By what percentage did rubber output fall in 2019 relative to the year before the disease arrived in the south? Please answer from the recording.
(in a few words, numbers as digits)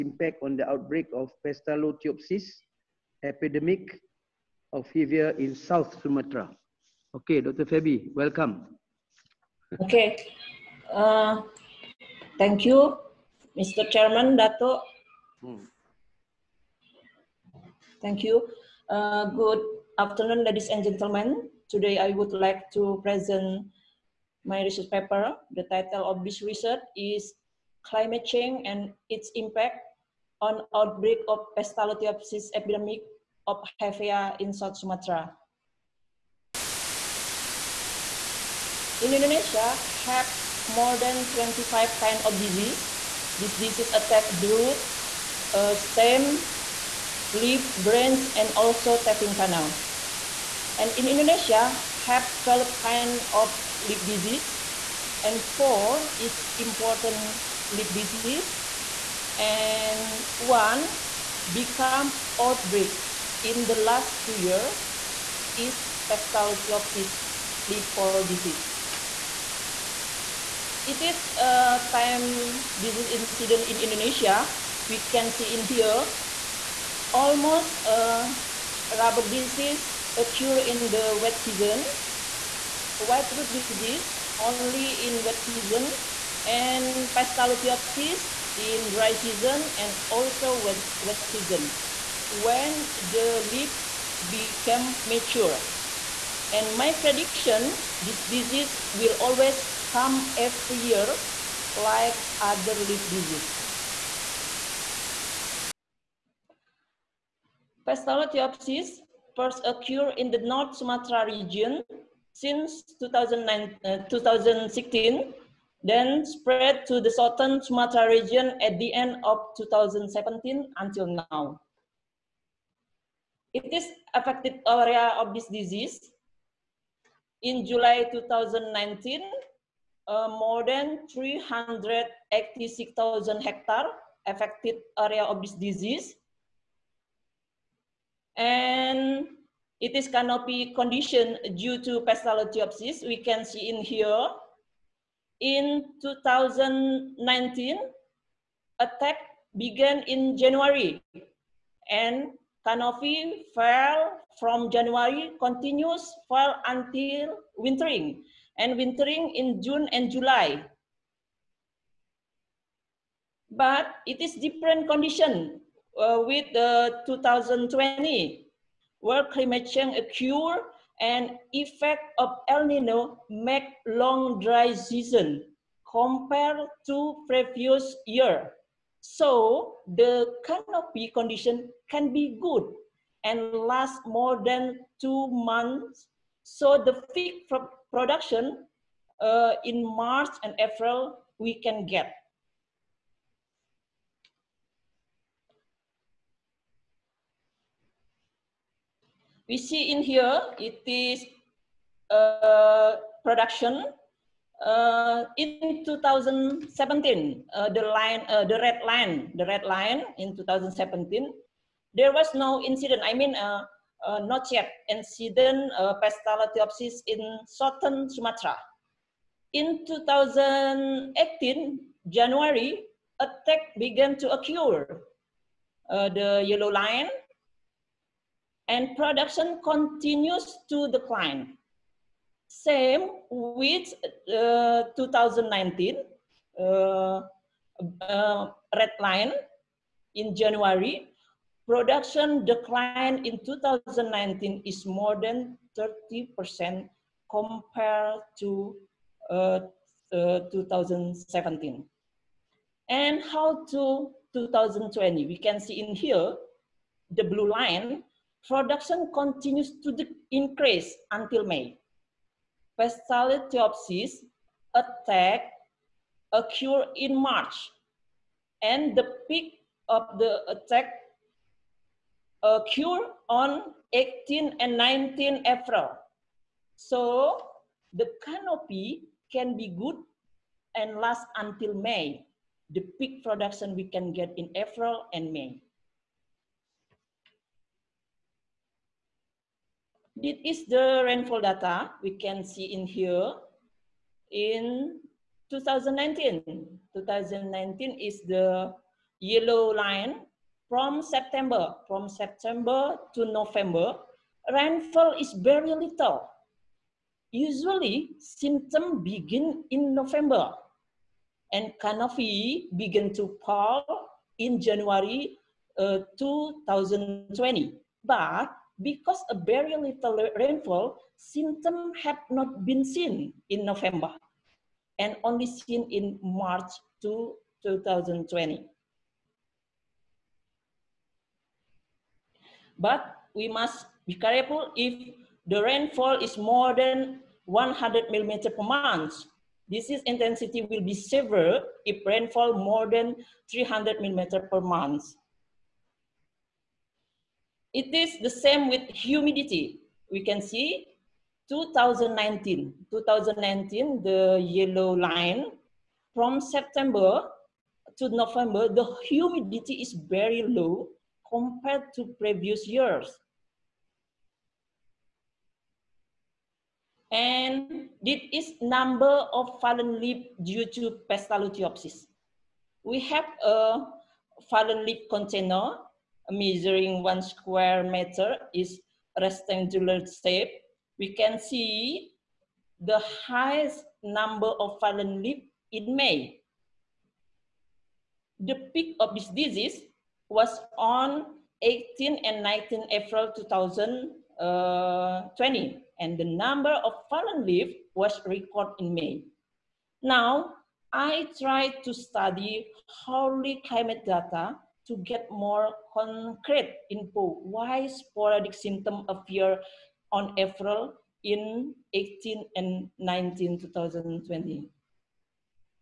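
more than 30%.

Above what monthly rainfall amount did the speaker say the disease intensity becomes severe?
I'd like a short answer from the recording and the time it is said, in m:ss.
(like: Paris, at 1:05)
300 millimeters, at 5:43.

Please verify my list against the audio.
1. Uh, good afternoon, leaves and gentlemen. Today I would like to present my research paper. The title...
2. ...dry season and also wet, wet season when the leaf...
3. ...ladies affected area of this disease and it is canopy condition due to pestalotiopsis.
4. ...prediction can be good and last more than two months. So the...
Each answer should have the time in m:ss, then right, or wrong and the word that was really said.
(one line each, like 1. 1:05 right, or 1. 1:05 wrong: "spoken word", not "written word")
1. 0:18 wrong: "ladies", not "leaves"
2. 1:28 right
3. 2:13 wrong: "hectares", not "ladies"
4. 3:01 wrong: "condition", not "prediction".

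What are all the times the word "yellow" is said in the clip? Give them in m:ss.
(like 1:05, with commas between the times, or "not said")
3:46, 4:59, 5:54.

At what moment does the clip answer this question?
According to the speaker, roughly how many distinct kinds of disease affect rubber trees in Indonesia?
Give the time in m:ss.
0:40.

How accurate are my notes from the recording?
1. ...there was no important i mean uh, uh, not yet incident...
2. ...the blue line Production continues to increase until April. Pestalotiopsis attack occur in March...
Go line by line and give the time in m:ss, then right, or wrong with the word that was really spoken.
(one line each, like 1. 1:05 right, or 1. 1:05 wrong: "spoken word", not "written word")
1. 3:31 wrong: "incident", not "important"
2. 4:17 wrong: "May", not "April".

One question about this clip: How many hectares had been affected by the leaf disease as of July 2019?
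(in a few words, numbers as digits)
more than 386,000.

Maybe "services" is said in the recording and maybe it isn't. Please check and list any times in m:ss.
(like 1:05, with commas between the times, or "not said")
not said.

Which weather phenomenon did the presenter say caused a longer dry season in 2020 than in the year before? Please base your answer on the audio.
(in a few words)
El Nino.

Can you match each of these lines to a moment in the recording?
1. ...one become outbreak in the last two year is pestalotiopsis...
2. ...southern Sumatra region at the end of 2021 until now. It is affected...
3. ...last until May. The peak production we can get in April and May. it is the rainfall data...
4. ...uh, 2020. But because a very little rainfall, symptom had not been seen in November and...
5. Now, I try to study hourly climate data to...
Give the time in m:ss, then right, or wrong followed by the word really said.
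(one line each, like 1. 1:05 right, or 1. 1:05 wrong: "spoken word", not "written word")
1. 1:00 right
2. 1:57 wrong: "2017", not "2021"
3. 4:40 right
4. 5:15 right
5. 6:40 right.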